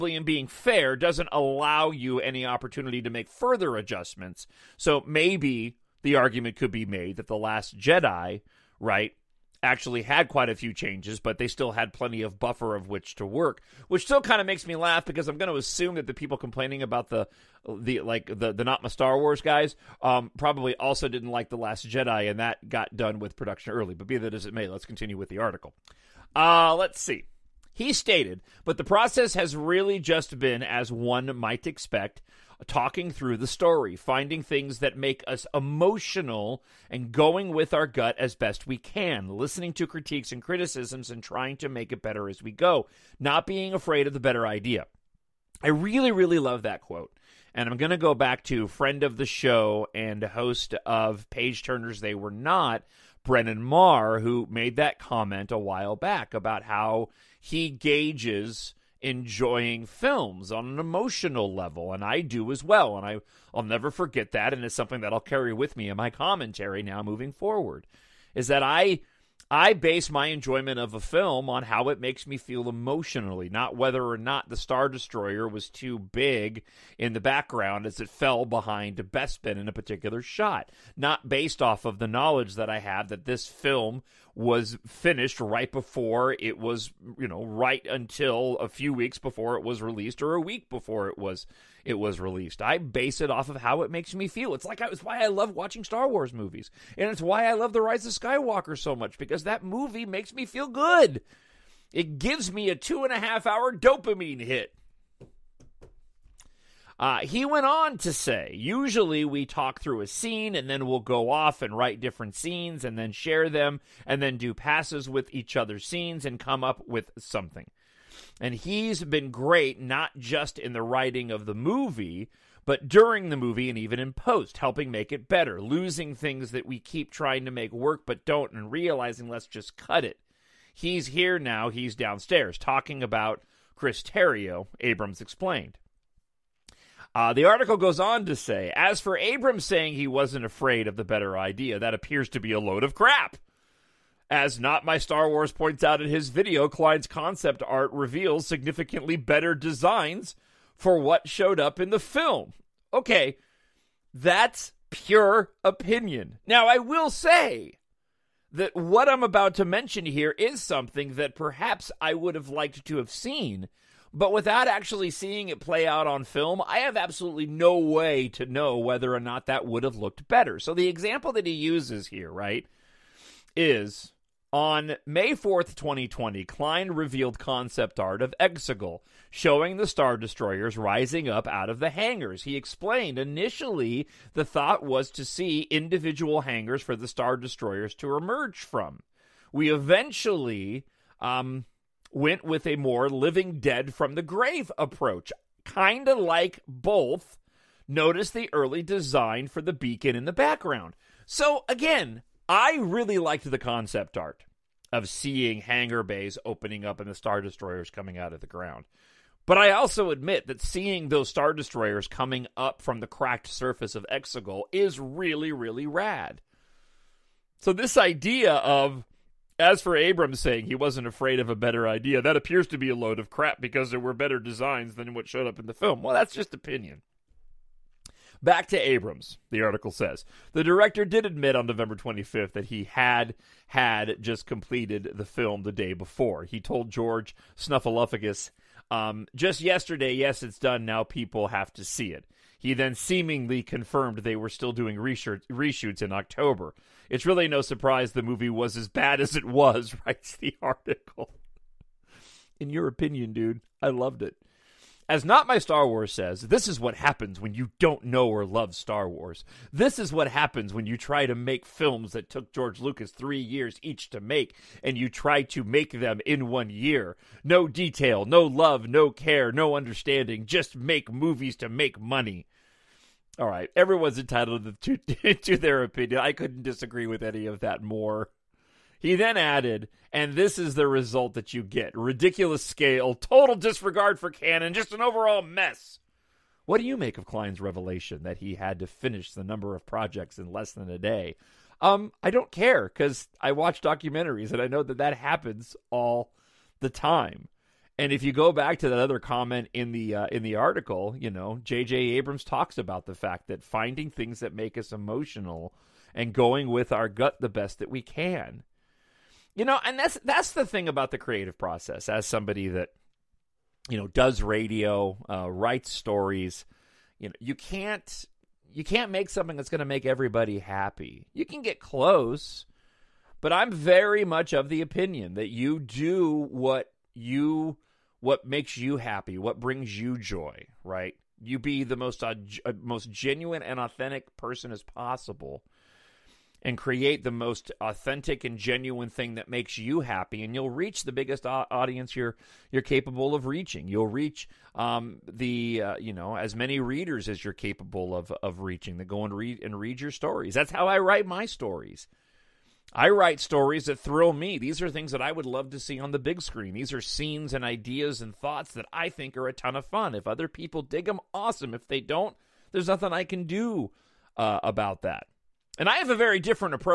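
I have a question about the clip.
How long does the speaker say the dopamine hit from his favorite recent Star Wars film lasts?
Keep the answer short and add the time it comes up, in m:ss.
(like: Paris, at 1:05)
two and a half hour, at 1:42.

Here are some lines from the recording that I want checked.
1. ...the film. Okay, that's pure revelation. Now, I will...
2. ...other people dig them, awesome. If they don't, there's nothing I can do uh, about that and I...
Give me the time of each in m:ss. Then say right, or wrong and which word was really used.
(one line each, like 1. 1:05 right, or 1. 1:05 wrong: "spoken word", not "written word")
1. 2:31 wrong: "opinion", not "revelation"
2. 6:00 right.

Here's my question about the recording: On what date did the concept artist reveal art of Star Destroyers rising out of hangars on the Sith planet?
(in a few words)
May 4th, 2020.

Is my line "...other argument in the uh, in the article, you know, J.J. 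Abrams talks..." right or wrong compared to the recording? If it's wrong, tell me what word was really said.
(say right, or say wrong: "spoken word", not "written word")
wrong: "comment", not "argument".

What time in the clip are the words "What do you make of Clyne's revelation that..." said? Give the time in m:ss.
4:46.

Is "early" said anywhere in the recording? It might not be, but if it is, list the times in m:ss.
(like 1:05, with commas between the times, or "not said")
0:23, 3:18.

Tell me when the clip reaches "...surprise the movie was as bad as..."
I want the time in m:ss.
4:07.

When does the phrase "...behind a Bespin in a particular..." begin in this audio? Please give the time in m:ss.
1:18.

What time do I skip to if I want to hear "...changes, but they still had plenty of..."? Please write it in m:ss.
0:10.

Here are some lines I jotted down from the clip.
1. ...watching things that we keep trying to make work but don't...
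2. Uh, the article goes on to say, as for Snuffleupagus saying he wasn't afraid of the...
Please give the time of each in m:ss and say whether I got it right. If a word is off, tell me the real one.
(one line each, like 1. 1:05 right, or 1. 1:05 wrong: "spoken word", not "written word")
1. 2:05 wrong: "losing", not "watching"
2. 2:17 wrong: "Abrams", not "Snuffleupagus".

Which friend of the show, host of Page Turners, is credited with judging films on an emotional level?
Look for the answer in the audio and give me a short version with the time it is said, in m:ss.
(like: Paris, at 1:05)
Brennan Marr, at 0:53.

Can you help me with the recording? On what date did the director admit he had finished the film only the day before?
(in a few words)
November 25th.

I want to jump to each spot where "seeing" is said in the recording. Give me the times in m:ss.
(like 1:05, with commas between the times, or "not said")
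2:45, 3:25, 3:30.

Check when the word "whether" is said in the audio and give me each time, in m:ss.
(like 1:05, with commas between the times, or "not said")
1:13, 2:48.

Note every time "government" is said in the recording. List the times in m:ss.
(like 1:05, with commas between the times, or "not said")
not said.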